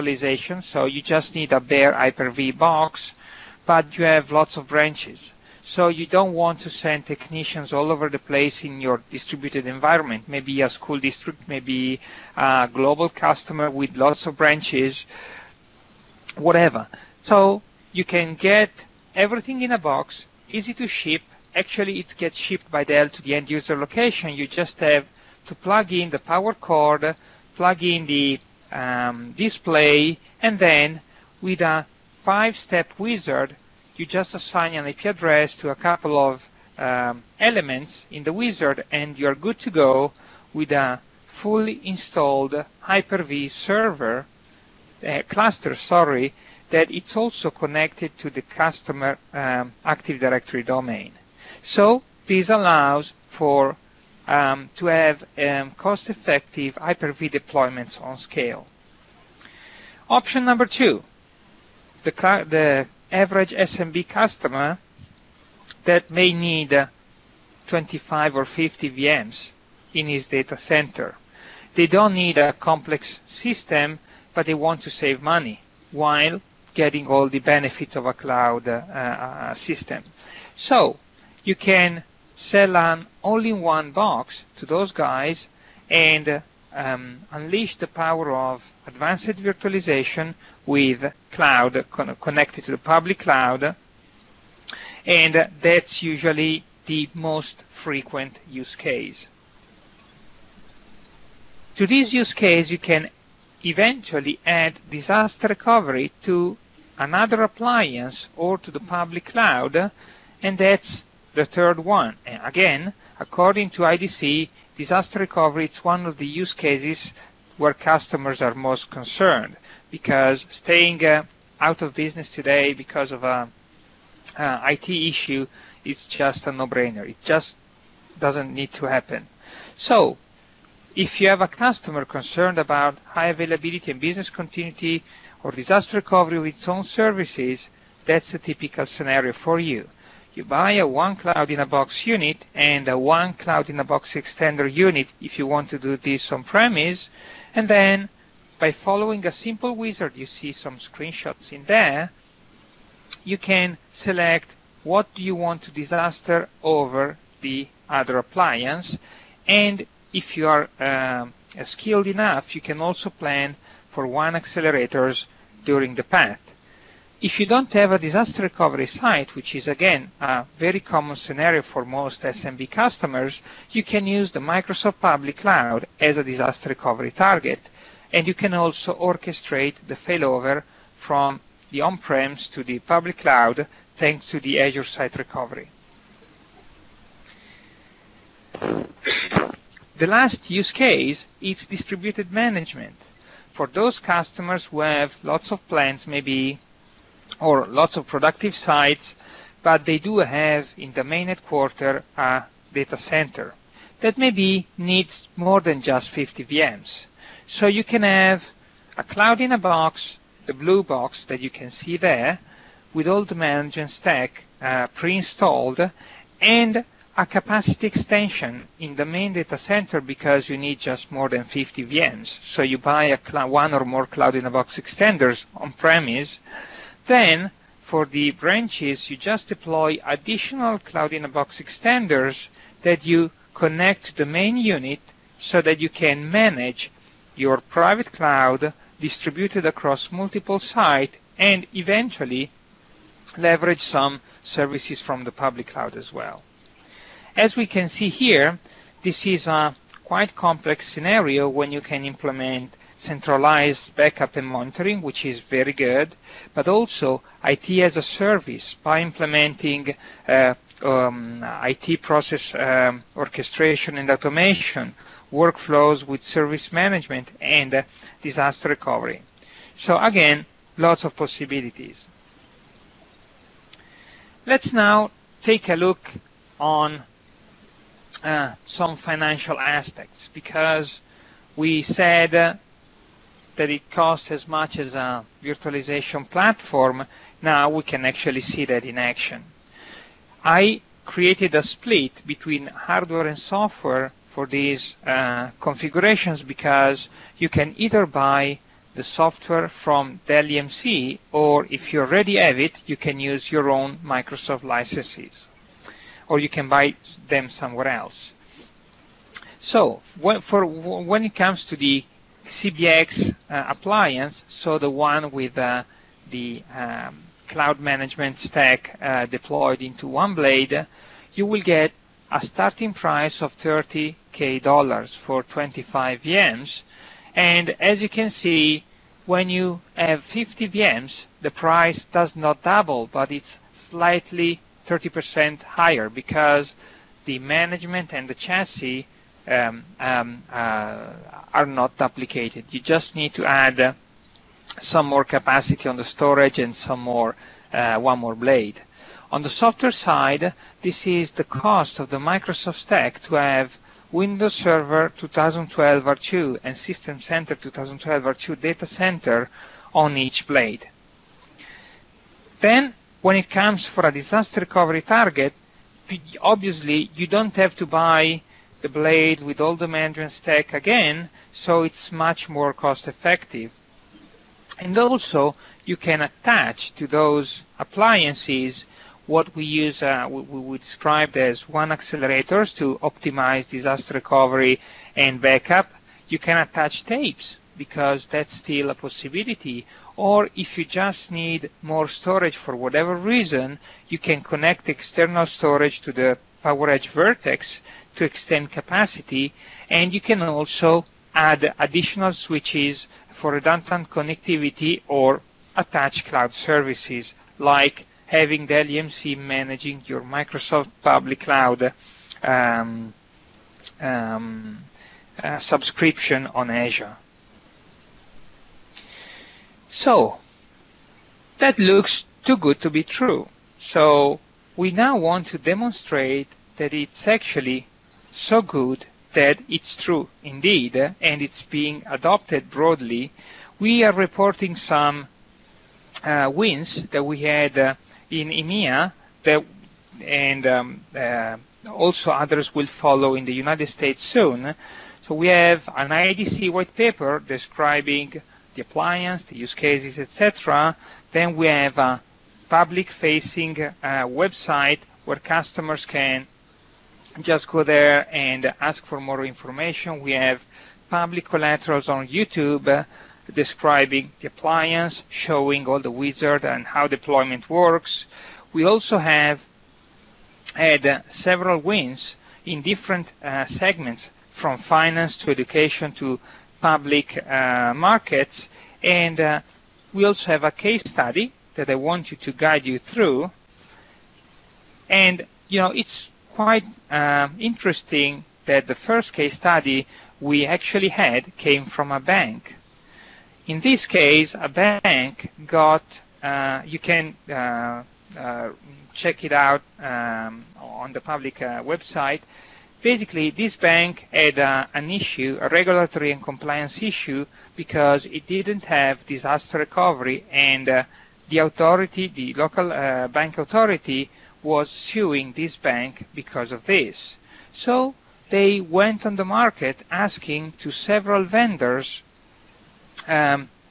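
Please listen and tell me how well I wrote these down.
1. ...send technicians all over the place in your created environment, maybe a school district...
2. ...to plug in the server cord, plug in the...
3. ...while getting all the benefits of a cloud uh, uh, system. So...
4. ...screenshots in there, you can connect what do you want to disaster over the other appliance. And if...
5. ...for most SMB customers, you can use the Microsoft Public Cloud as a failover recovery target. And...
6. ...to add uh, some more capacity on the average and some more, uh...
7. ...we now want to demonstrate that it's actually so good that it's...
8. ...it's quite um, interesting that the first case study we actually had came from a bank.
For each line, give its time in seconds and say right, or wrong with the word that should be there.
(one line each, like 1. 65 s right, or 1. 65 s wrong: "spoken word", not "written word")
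1. 6 s wrong: "distributed", not "created"
2. 25 s wrong: "power", not "server"
3. 75 s right
4. 150 s wrong: "select", not "connect"
5. 171 s wrong: "disaster", not "failover"
6. 343 s wrong: "storage", not "average"
7. 424 s right
8. 485 s right.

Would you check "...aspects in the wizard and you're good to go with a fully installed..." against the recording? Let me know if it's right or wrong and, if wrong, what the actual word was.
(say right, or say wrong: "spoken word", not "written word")
wrong: "elements", not "aspects".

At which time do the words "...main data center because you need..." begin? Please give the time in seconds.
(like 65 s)
219 s.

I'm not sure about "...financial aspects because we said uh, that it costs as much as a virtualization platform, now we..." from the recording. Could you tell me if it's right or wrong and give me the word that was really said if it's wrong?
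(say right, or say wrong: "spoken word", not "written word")
right.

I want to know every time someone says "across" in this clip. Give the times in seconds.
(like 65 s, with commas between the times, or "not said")
239 s.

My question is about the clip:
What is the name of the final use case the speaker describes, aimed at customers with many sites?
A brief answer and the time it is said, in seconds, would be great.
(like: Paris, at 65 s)
Distributed management, at 191 s.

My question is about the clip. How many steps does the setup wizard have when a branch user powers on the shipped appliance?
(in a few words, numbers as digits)
5.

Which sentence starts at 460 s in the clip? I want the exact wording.
We have public collaterals on YouTube uh, describing the appliance, showing all the wizard and how deployment works.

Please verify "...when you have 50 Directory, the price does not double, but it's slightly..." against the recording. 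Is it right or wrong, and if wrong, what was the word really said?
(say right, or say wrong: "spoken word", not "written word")
wrong: "VMs", not "Directory".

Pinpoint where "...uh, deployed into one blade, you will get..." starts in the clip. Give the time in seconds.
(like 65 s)
319 s.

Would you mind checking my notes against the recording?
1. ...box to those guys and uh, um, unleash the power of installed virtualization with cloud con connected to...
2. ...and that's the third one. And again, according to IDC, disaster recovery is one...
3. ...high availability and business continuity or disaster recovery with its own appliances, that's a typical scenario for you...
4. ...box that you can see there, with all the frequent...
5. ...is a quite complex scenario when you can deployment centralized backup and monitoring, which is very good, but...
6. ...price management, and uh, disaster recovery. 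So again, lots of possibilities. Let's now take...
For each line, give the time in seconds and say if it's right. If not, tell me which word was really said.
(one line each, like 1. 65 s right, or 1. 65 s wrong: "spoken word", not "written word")
1. 83 s wrong: "advanced", not "installed"
2. 110 s right
3. 133 s wrong: "services", not "appliances"
4. 210 s wrong: "management", not "frequent"
5. 249 s wrong: "implement", not "deployment"
6. 266 s wrong: "service", not "price".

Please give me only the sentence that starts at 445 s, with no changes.
So we have an IDC white paper describing the appliance, the use cases, etc.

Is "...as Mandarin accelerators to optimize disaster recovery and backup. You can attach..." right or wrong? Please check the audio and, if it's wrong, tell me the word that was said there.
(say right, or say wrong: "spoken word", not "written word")
wrong: "WAN", not "Mandarin".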